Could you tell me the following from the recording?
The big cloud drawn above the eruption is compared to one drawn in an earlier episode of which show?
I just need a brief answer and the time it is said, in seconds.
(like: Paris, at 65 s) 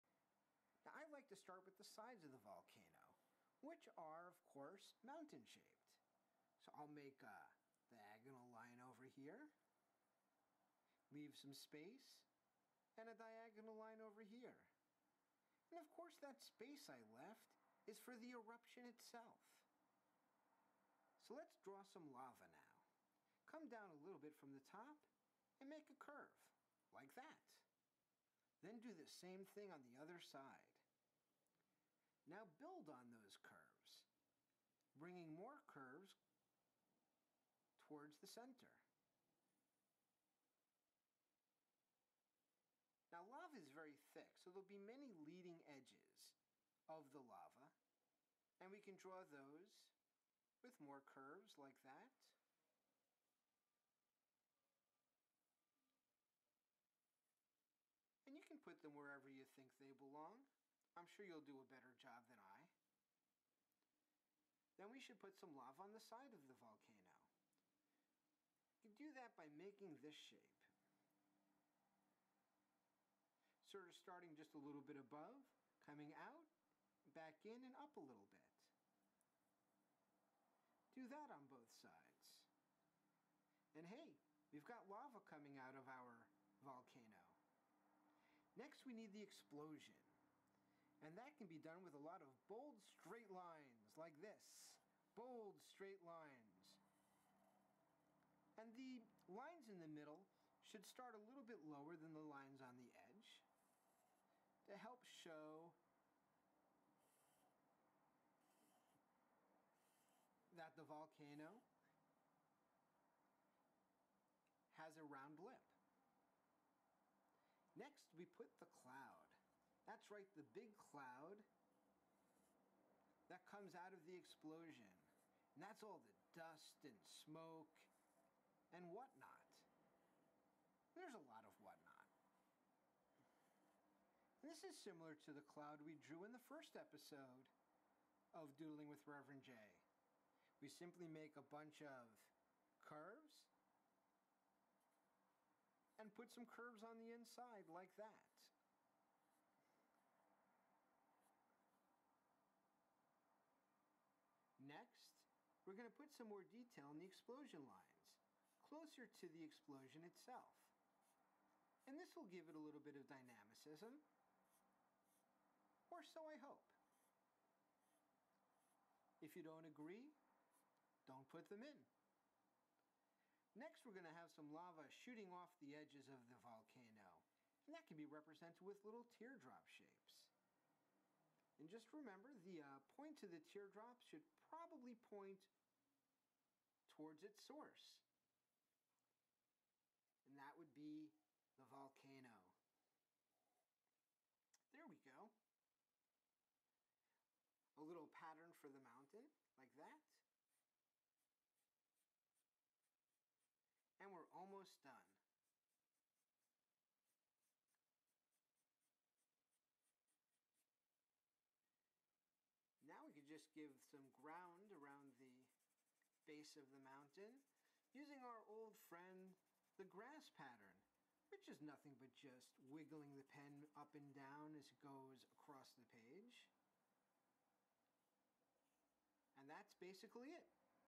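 Doodling with Reverend J, at 138 s.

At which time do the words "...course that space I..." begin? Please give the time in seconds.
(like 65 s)
15 s.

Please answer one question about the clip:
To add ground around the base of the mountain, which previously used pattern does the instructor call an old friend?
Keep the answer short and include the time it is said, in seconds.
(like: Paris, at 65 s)
the grass pattern, at 219 s.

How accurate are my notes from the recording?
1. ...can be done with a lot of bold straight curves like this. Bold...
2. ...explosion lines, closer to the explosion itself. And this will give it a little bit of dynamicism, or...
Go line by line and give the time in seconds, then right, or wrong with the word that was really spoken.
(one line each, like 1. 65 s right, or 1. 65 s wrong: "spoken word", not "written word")
1. 91 s wrong: "lines", not "curves"
2. 157 s right.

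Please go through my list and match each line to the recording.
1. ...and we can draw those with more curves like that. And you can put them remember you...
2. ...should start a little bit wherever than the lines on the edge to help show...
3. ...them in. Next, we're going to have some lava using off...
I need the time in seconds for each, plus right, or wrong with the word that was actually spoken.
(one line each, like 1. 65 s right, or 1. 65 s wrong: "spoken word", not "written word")
1. 48 s wrong: "wherever", not "remember"
2. 100 s wrong: "lower", not "wherever"
3. 171 s wrong: "shooting", not "using".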